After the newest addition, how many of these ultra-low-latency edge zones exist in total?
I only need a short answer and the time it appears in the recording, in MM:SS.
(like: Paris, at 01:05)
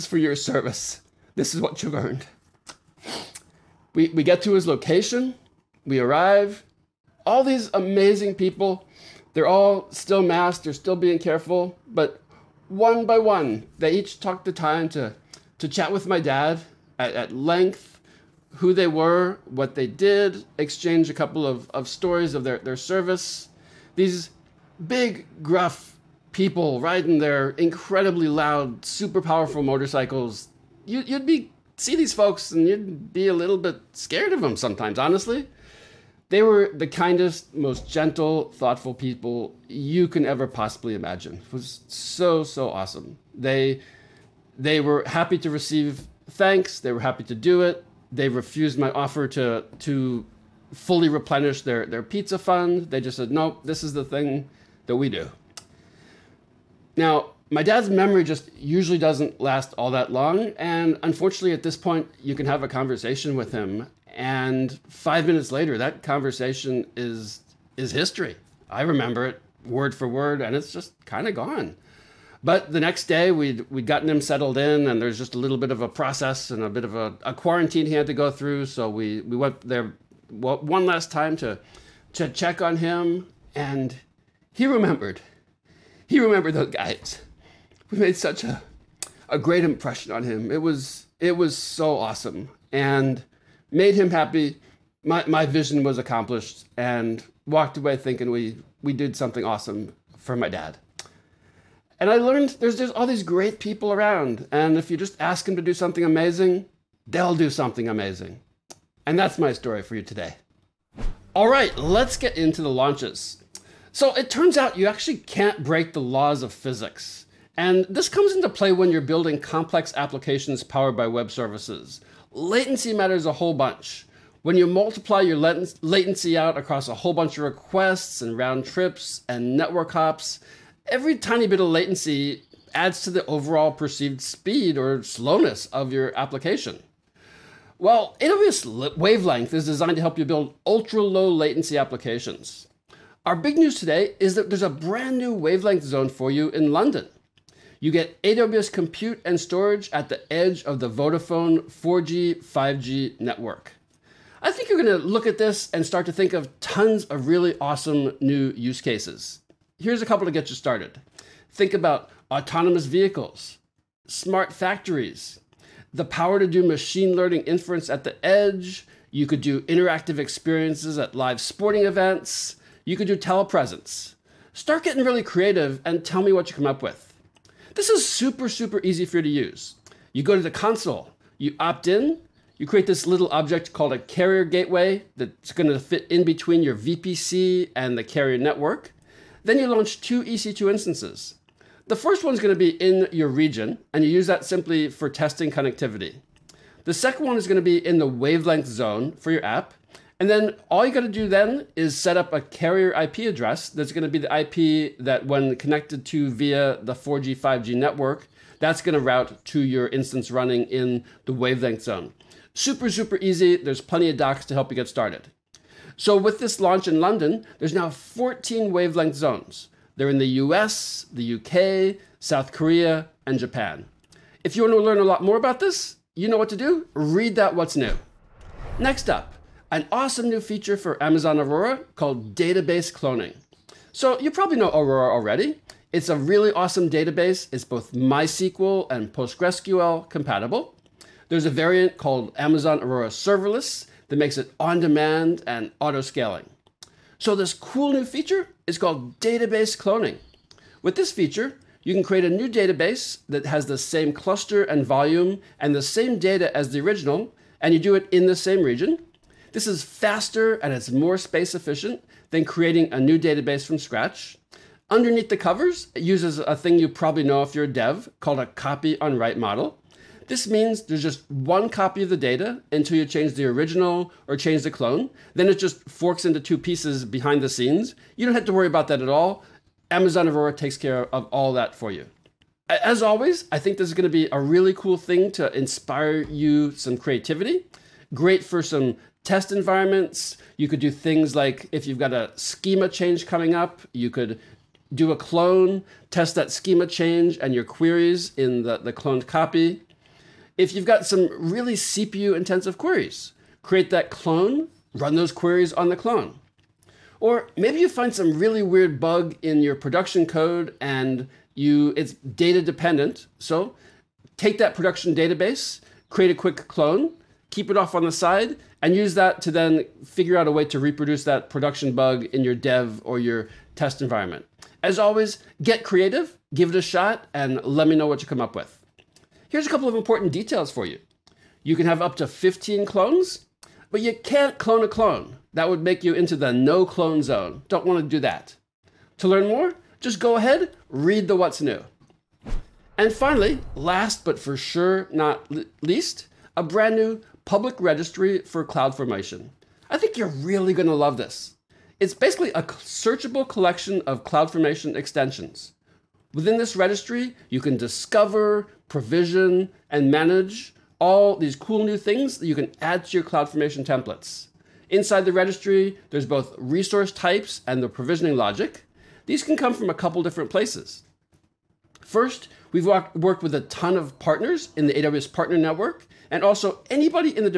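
14, at 03:37.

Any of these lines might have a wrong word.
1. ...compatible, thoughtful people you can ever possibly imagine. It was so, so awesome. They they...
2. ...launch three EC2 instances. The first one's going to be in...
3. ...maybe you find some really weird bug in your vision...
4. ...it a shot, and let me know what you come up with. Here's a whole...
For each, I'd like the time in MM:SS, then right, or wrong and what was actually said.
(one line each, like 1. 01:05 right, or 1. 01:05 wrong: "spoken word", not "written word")
1. 00:37 wrong: "gentle", not "compatible"
2. 03:09 wrong: "two", not "three"
3. 05:07 wrong: "production", not "vision"
4. 05:26 wrong: "couple", not "whole".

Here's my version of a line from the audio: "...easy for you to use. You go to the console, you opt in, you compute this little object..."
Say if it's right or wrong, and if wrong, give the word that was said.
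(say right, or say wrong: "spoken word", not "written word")
wrong: "create", not "compute".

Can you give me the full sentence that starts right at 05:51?
It's basically a searchable collection of CloudFormation extensions.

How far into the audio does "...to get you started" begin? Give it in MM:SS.
02:40.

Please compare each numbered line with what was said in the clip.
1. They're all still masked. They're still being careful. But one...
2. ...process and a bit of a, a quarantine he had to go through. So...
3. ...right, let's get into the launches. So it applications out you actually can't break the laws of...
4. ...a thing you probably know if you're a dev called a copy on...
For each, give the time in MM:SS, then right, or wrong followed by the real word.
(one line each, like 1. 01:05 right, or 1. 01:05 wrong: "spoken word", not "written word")
1. 00:09 right
2. 01:15 right
3. 01:51 wrong: "turns", not "applications"
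4. 04:26 right.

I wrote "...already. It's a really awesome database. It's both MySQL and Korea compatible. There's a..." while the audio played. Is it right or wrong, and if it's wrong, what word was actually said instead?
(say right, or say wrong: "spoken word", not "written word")
wrong: "PostgreSQL", not "Korea".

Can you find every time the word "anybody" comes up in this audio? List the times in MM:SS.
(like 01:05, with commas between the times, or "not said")
06:16.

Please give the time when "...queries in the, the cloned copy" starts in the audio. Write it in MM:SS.
04:57.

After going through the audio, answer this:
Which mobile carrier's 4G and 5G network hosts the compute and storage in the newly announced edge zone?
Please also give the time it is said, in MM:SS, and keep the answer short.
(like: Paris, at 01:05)
Vodafone, at 02:30.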